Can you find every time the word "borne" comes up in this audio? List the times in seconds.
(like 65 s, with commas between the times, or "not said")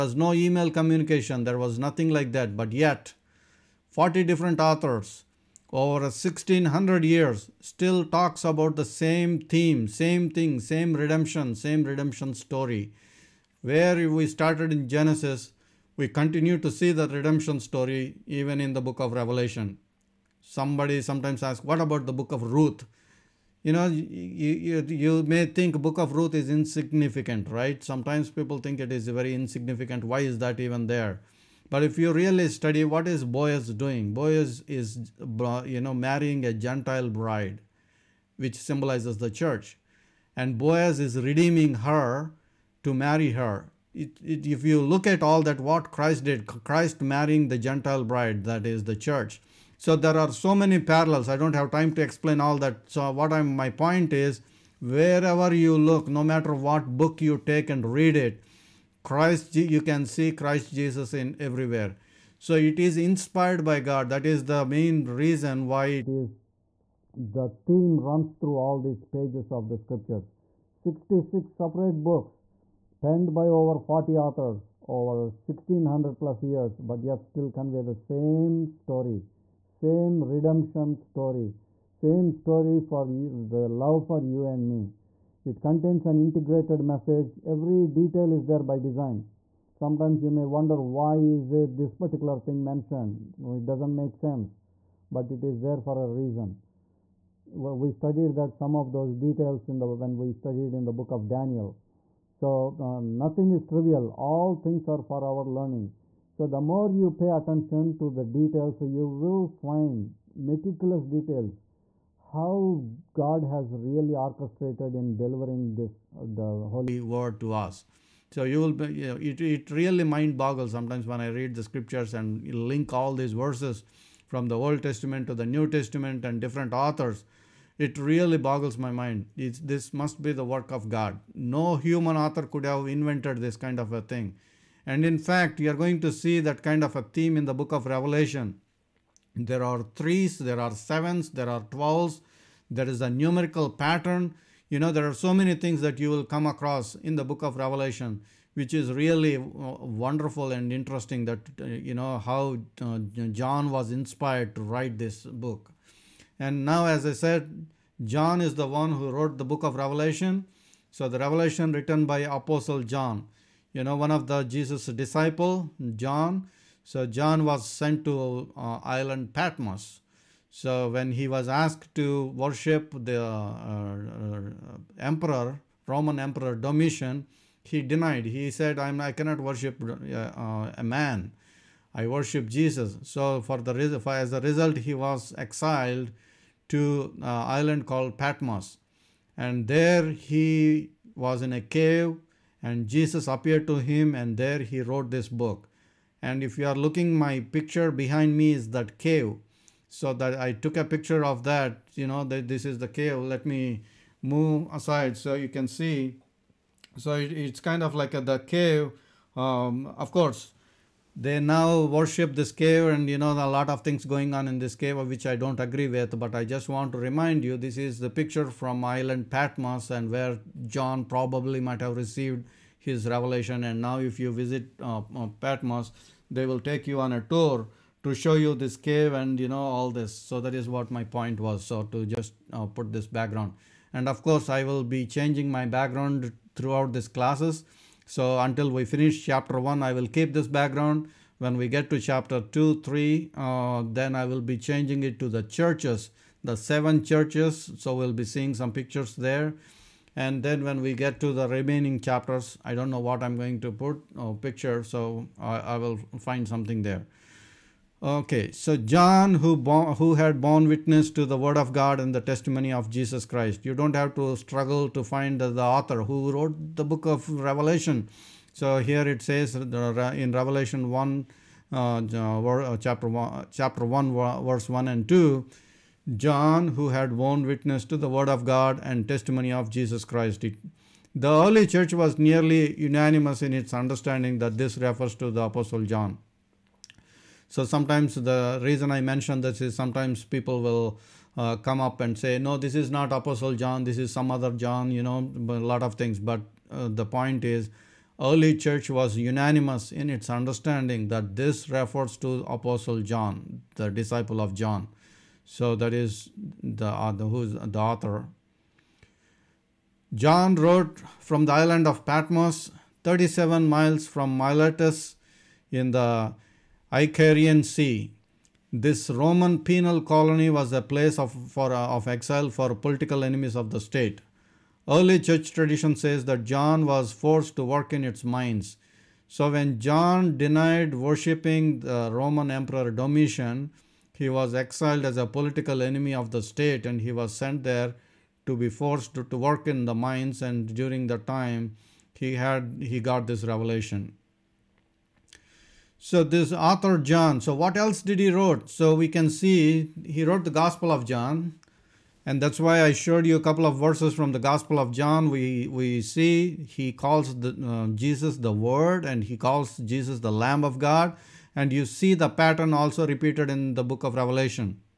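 260 s, 277 s.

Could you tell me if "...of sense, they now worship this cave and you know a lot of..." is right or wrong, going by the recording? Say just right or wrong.
wrong.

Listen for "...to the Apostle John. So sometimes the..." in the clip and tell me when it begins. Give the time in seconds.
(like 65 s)
285 s.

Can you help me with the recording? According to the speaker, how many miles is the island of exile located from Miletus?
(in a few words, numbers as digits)
37.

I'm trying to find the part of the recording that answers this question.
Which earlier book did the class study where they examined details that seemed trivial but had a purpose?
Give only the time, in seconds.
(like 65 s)
100 s.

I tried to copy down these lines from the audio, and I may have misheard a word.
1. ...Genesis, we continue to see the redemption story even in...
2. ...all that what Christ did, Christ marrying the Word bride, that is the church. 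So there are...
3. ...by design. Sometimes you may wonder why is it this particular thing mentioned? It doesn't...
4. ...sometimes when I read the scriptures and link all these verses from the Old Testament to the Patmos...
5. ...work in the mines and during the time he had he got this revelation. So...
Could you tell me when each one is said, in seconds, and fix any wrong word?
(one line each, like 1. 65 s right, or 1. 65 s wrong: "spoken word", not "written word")
1. 14 s right
2. 45 s wrong: "Gentile", not "Word"
3. 88 s right
4. 120 s wrong: "New", not "Patmos"
5. 339 s right.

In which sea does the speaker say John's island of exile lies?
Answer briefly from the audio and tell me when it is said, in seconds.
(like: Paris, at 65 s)
Icarian Sea, at 316 s.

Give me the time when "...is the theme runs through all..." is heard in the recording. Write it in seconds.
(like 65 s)
66 s.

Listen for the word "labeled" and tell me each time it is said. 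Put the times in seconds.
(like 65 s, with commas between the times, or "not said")
not said.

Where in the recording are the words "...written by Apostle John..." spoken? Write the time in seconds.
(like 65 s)
161 s.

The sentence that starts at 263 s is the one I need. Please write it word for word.
You don't have to struggle to find the author who wrote the book of Revelation.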